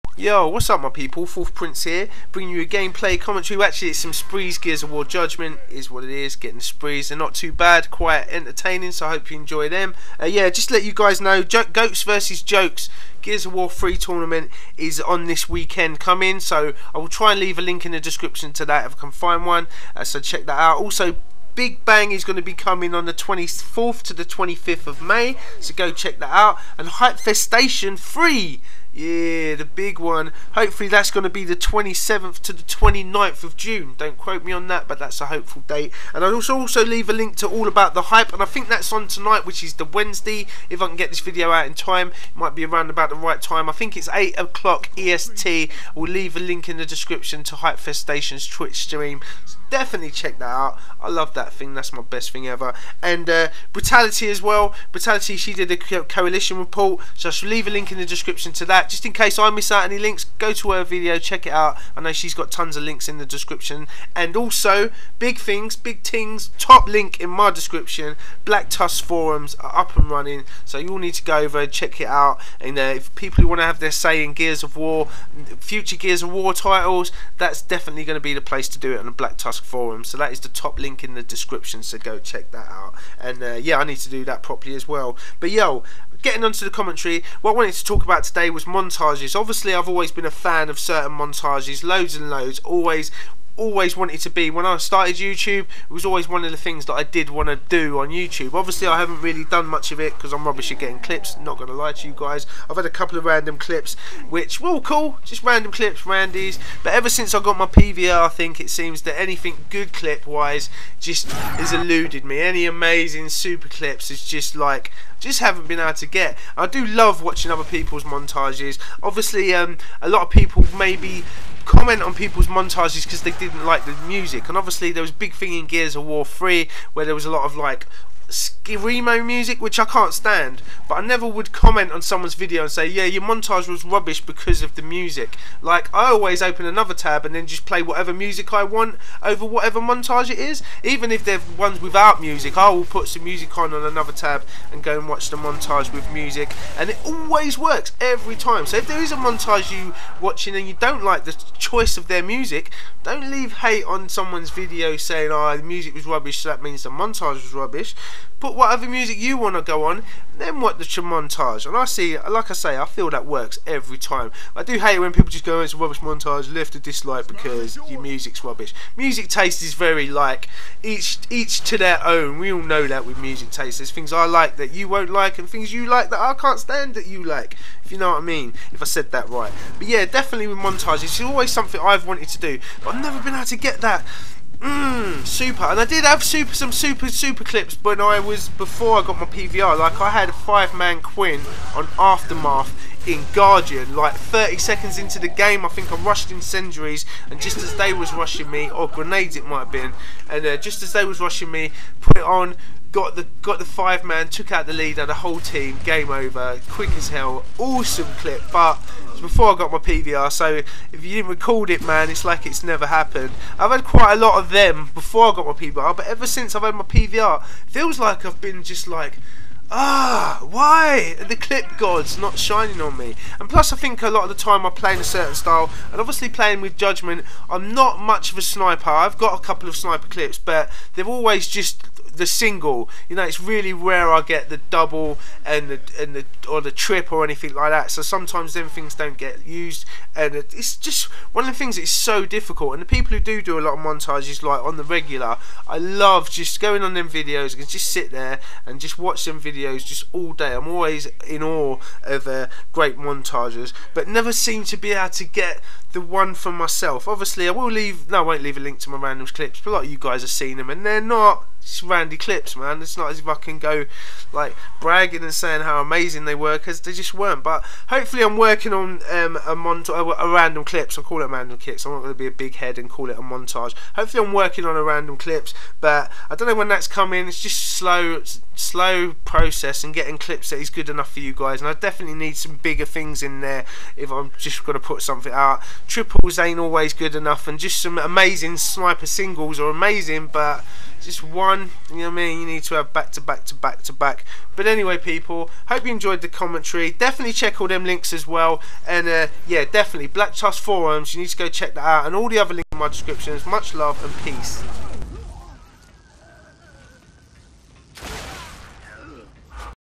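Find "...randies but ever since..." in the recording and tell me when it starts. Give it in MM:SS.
01:46.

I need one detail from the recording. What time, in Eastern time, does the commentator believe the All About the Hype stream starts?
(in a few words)
8 o'clock.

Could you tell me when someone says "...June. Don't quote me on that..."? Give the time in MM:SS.
00:33.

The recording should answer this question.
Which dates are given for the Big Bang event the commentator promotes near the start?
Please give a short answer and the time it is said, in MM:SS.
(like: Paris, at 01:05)
24th to 25th of May, at 00:23.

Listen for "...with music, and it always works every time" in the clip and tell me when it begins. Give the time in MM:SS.
02:25.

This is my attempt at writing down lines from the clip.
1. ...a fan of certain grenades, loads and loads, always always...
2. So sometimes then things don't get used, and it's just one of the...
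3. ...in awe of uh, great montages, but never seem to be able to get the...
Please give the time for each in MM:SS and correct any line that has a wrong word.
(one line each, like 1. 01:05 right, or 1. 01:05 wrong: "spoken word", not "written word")
1. 01:30 wrong: "montages", not "grenades"
2. 03:57 right
3. 04:11 right.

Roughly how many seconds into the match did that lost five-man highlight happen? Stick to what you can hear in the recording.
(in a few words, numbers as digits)
30.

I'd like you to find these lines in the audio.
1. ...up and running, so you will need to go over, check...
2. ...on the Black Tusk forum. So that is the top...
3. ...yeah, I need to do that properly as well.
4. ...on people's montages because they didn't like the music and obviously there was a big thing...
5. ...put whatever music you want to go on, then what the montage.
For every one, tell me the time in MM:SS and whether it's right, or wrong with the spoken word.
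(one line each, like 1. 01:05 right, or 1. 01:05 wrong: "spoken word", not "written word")
1. 01:09 right
2. 01:18 right
3. 01:23 right
4. 02:02 right
5. 02:38 right.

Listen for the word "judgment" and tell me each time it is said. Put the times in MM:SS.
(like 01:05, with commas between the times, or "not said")
00:05, 03:46.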